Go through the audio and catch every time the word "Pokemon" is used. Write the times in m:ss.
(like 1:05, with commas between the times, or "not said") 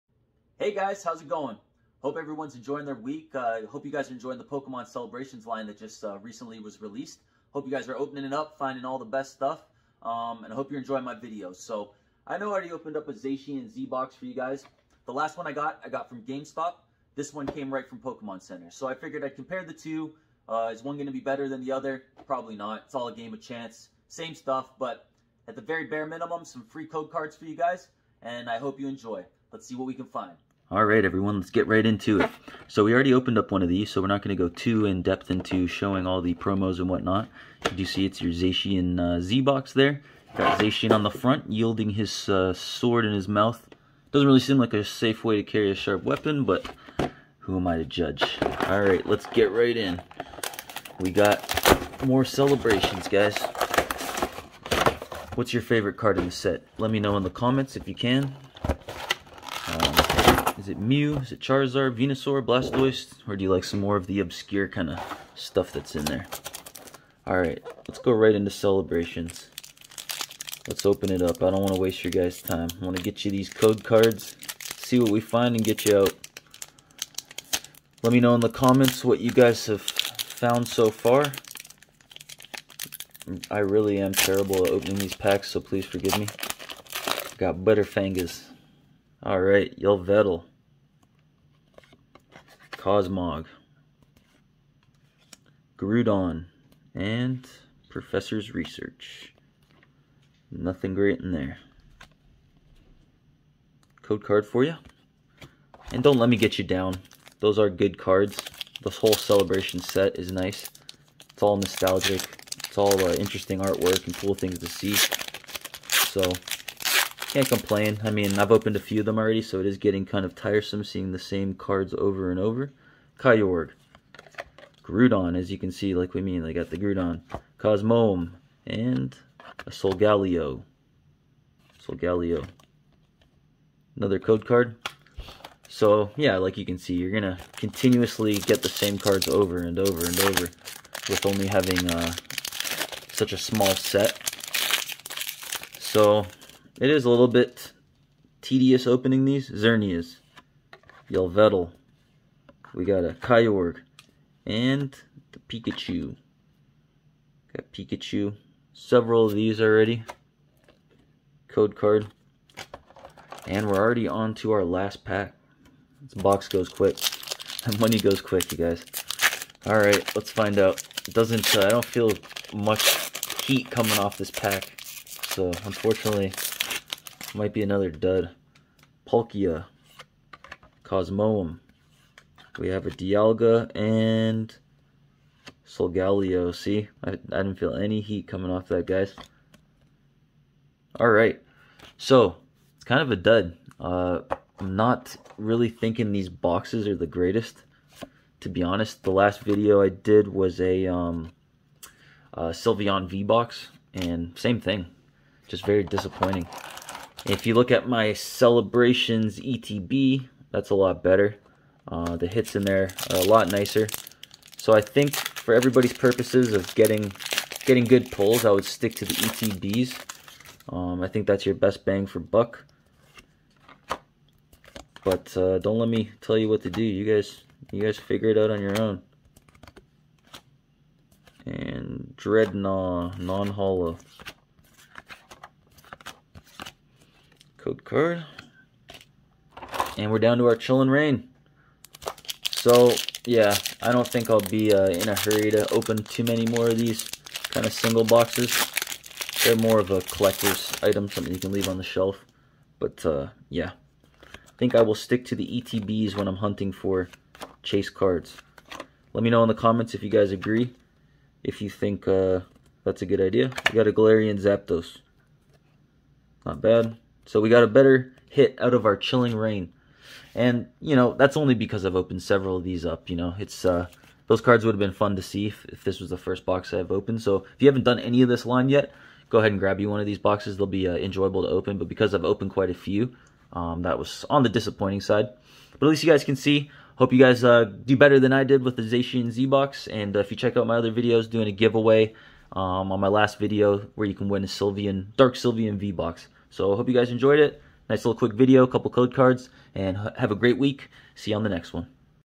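0:04, 0:17.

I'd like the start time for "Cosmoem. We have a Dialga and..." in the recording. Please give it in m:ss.
3:00.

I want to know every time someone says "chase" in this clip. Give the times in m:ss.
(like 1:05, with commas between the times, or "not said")
4:17.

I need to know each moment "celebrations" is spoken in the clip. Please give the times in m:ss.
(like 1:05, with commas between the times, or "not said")
0:04, 0:52, 1:08, 1:49, 3:28.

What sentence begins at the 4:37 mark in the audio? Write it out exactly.
So if you haven't done any of this line yet, go ahead and grab you one of these boxes.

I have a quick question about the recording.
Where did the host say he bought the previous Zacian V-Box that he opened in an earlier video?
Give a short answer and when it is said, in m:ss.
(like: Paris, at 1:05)
GameStop, at 0:16.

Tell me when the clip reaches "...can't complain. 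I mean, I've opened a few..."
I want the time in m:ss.
1:57.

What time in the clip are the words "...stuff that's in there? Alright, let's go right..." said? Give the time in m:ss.
1:05.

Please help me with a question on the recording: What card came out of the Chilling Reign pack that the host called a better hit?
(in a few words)
Galarian Zapdos.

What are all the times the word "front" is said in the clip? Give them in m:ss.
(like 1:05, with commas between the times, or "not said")
0:41.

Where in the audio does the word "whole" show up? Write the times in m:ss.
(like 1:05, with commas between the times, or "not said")
1:48.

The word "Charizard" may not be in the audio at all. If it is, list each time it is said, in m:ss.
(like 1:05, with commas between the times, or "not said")
1:01.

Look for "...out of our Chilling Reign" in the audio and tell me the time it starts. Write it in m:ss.
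4:28.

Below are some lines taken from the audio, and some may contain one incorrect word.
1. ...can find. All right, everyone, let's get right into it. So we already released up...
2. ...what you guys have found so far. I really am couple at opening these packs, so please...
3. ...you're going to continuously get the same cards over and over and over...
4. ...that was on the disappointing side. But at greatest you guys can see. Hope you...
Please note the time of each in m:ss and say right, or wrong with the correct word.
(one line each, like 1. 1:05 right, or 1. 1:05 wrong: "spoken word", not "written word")
1. 0:29 wrong: "opened", not "released"
2. 1:19 wrong: "terrible", not "couple"
3. 2:16 right
4. 4:43 wrong: "least", not "greatest".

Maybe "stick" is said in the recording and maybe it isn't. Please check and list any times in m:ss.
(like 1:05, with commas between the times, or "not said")
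3:38, 4:14.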